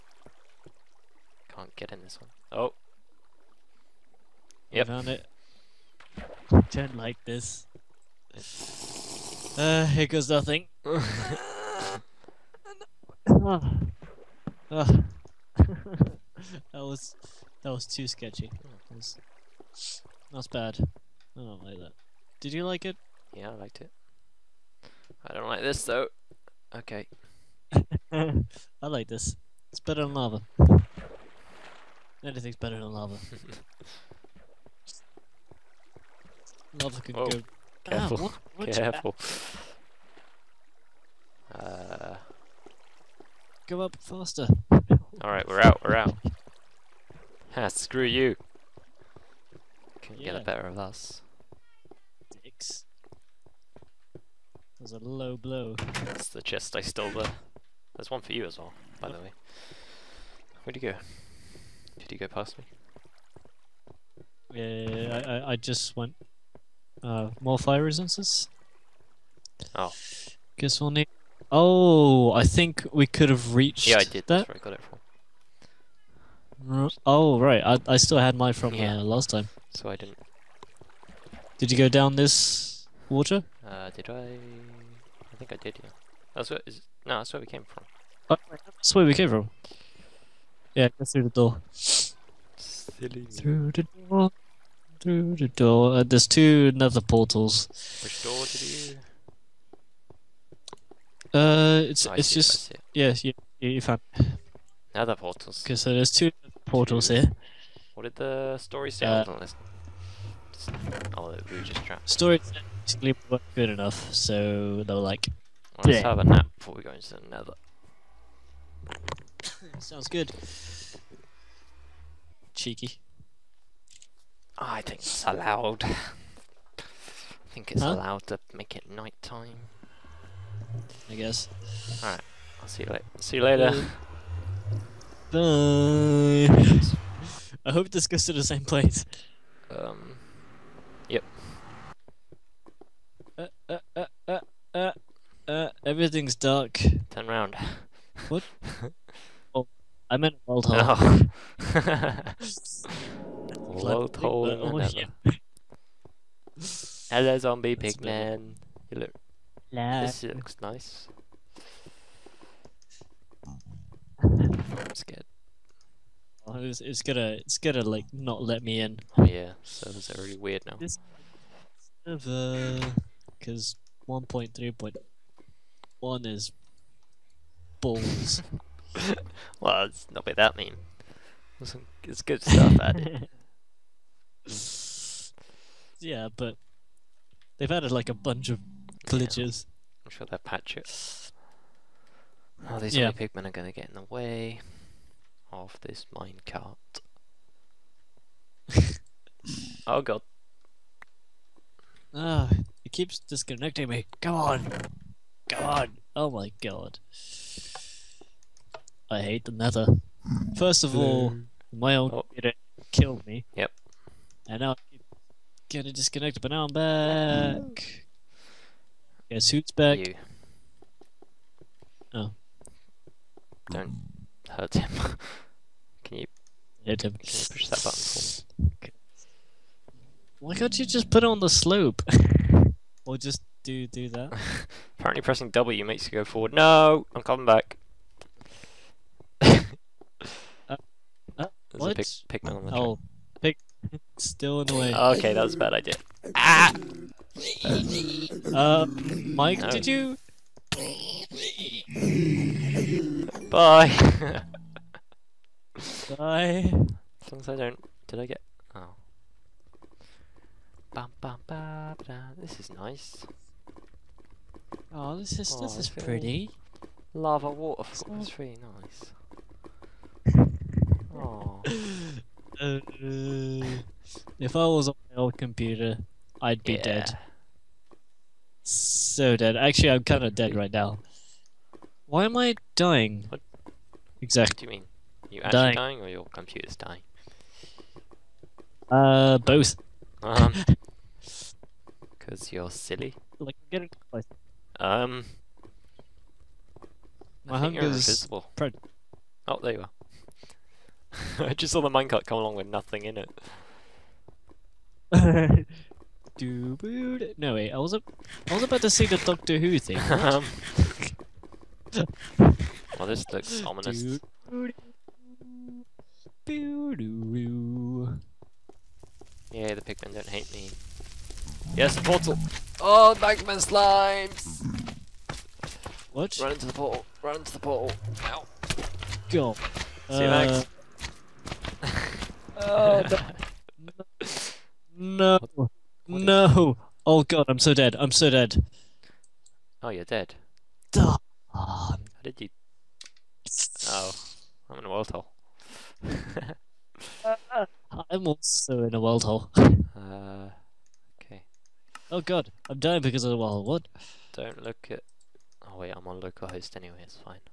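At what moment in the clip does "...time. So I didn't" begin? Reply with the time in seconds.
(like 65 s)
79 s.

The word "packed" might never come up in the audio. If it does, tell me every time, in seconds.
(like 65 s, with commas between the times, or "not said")
not said.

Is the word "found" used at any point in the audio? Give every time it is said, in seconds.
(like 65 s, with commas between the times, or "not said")
4 s, 103 s.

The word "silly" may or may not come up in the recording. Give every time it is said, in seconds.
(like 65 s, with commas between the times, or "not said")
91 s, 292 s.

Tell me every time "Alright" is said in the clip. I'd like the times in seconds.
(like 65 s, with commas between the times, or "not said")
45 s, 132 s.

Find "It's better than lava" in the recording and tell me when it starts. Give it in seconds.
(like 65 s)
29 s.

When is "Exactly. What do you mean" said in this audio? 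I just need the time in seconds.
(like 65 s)
284 s.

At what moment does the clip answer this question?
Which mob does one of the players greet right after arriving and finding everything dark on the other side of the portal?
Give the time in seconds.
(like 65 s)
157 s.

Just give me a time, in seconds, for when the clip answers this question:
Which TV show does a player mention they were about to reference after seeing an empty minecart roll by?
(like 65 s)
309 s.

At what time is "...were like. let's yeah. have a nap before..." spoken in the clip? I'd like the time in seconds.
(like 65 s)
114 s.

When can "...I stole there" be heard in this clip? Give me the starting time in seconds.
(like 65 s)
56 s.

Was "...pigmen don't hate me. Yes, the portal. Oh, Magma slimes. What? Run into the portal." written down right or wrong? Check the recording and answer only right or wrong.
right.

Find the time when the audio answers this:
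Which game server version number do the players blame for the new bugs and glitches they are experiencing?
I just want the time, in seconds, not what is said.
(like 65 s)
174 s.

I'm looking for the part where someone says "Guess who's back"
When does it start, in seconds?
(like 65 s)
219 s.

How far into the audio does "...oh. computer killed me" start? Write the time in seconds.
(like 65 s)
212 s.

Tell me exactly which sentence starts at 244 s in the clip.
Okay, that was a bad idea.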